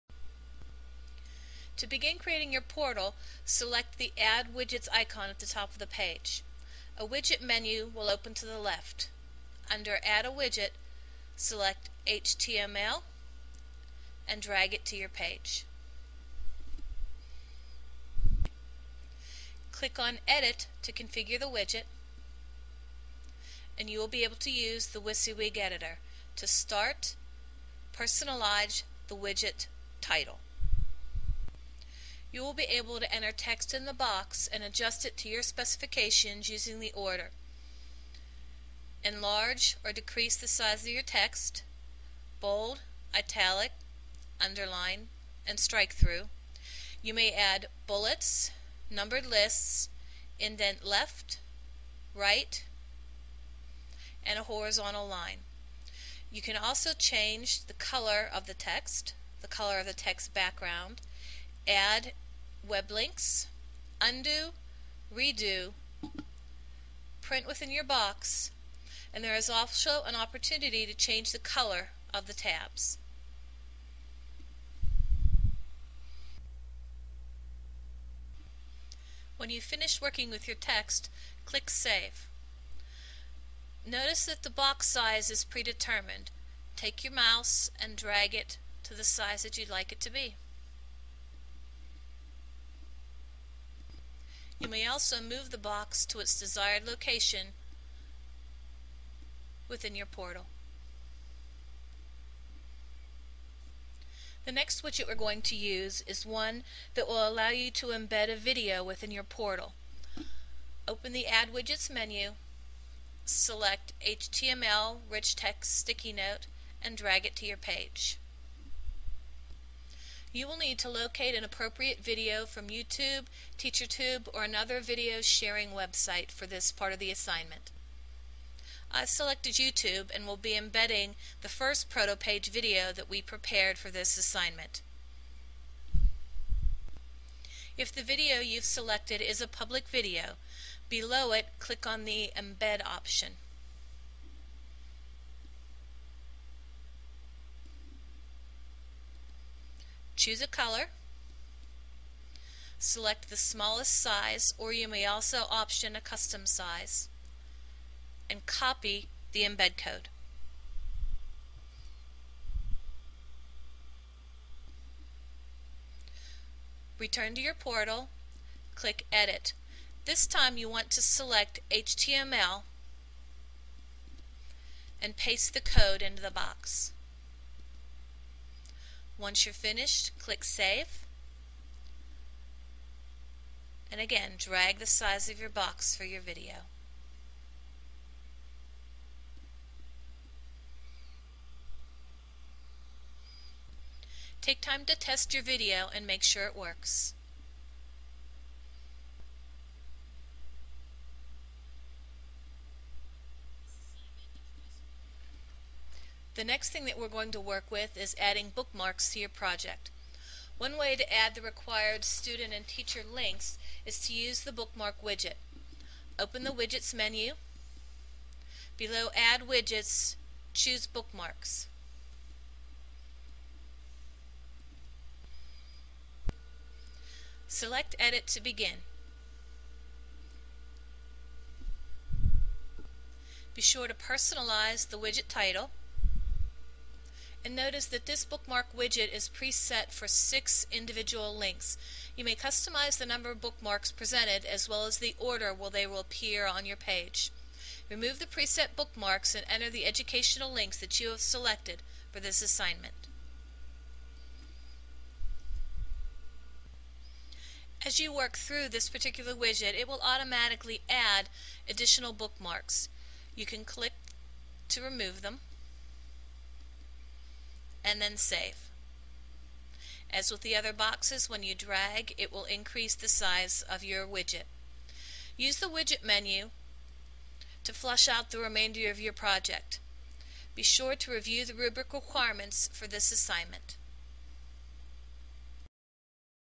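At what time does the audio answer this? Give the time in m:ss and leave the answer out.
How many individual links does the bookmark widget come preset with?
4:00.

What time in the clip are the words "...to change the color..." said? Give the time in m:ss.
1:10.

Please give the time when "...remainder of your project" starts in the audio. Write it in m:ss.
4:38.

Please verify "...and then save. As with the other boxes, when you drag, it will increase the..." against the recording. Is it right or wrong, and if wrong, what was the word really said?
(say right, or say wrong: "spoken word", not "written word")
right.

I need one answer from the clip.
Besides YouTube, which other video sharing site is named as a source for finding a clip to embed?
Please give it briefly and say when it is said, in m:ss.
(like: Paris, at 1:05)
TeacherTube, at 2:03.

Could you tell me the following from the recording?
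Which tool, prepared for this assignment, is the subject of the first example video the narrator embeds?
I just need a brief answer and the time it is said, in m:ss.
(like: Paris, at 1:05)
Protopage, at 2:11.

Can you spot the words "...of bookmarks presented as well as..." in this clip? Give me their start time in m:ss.
4:03.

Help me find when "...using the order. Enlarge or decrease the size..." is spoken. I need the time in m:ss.
0:36.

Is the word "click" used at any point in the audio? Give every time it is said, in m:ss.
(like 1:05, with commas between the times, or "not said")
0:19, 1:21, 2:21, 2:48, 3:00, 4:23.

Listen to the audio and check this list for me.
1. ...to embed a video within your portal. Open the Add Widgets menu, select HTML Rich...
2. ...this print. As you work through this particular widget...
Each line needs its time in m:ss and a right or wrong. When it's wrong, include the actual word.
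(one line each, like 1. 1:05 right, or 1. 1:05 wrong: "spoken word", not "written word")
1. 1:47 right
2. 4:12 wrong: "assignment", not "print".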